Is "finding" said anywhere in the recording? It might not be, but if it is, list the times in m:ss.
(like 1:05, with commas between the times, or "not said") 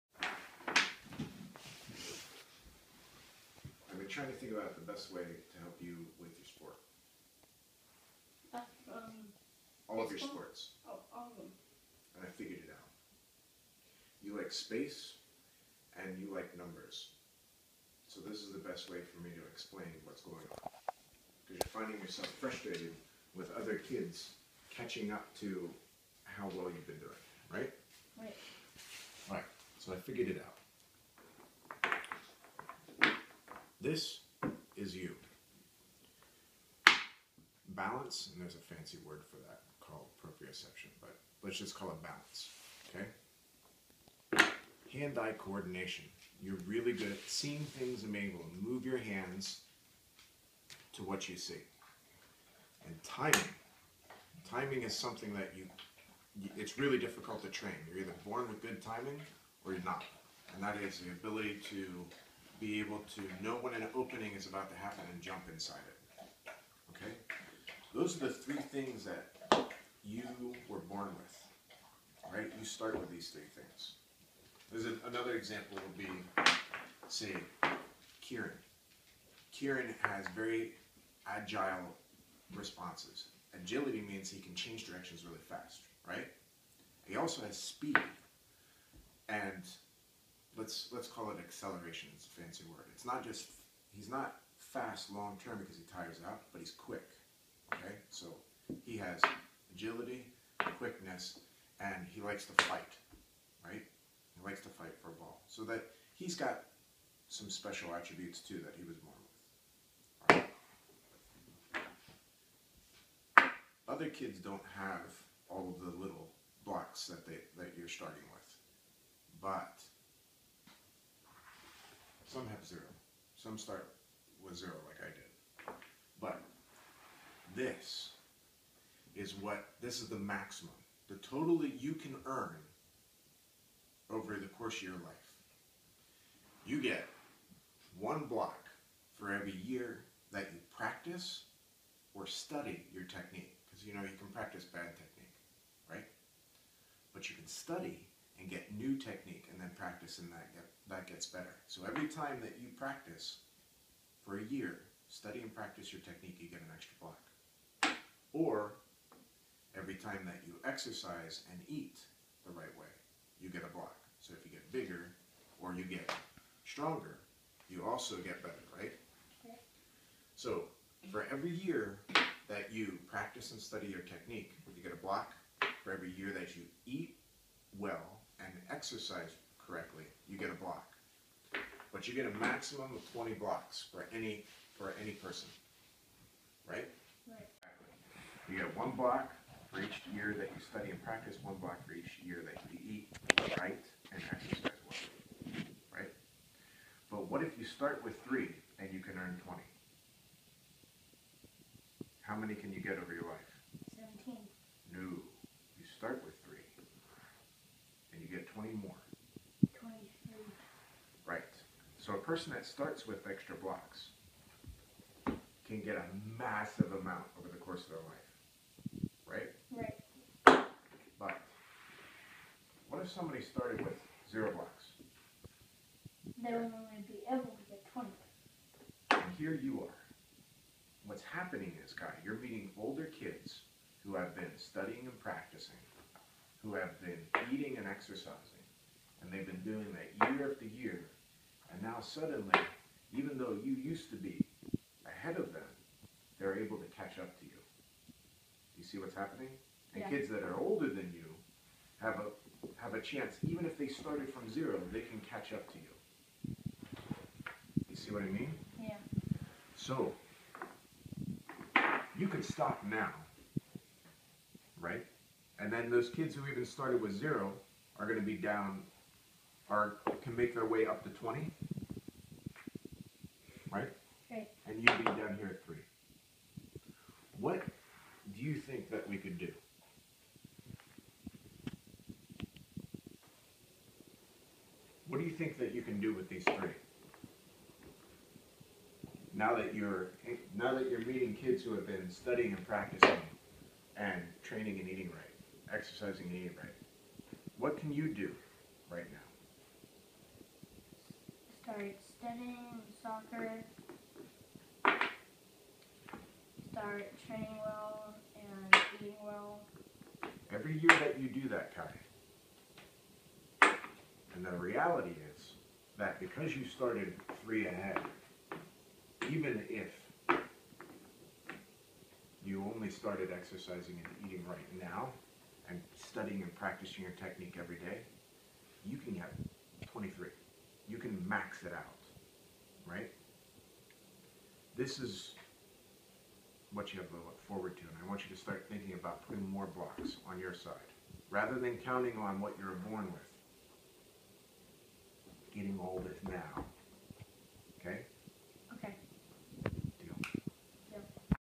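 0:21.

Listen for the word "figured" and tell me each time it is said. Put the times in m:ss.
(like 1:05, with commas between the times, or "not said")
0:12, 0:29.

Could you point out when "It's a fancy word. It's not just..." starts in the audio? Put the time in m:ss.
1:32.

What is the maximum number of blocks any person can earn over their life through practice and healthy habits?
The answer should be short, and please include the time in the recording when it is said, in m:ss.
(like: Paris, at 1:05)
20, at 3:03.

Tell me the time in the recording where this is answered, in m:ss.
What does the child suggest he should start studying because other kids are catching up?
5:03.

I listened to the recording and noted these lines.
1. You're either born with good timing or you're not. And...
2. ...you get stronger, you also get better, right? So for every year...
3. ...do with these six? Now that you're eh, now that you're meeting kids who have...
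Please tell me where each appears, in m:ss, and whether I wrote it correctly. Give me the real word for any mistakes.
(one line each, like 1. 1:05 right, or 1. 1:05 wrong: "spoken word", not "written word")
1. 0:57 right
2. 2:45 right
3. 4:46 wrong: "three", not "six".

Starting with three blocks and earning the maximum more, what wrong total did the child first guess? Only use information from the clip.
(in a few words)
17.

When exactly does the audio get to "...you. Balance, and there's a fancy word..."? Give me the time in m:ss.
0:34.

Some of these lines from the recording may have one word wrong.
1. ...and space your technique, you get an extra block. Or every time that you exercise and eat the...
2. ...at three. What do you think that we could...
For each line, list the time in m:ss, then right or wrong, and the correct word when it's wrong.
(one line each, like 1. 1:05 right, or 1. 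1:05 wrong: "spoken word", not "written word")
1. 2:35 wrong: "practice", not "space"
2. 4:35 right.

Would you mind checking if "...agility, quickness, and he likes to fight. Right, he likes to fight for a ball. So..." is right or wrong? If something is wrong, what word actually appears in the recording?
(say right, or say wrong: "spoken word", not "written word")
right.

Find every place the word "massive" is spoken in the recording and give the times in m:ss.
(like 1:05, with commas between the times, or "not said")
3:36.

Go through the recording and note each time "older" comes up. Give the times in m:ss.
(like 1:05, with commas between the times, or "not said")
3:52, 4:10.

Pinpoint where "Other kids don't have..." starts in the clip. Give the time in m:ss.
1:53.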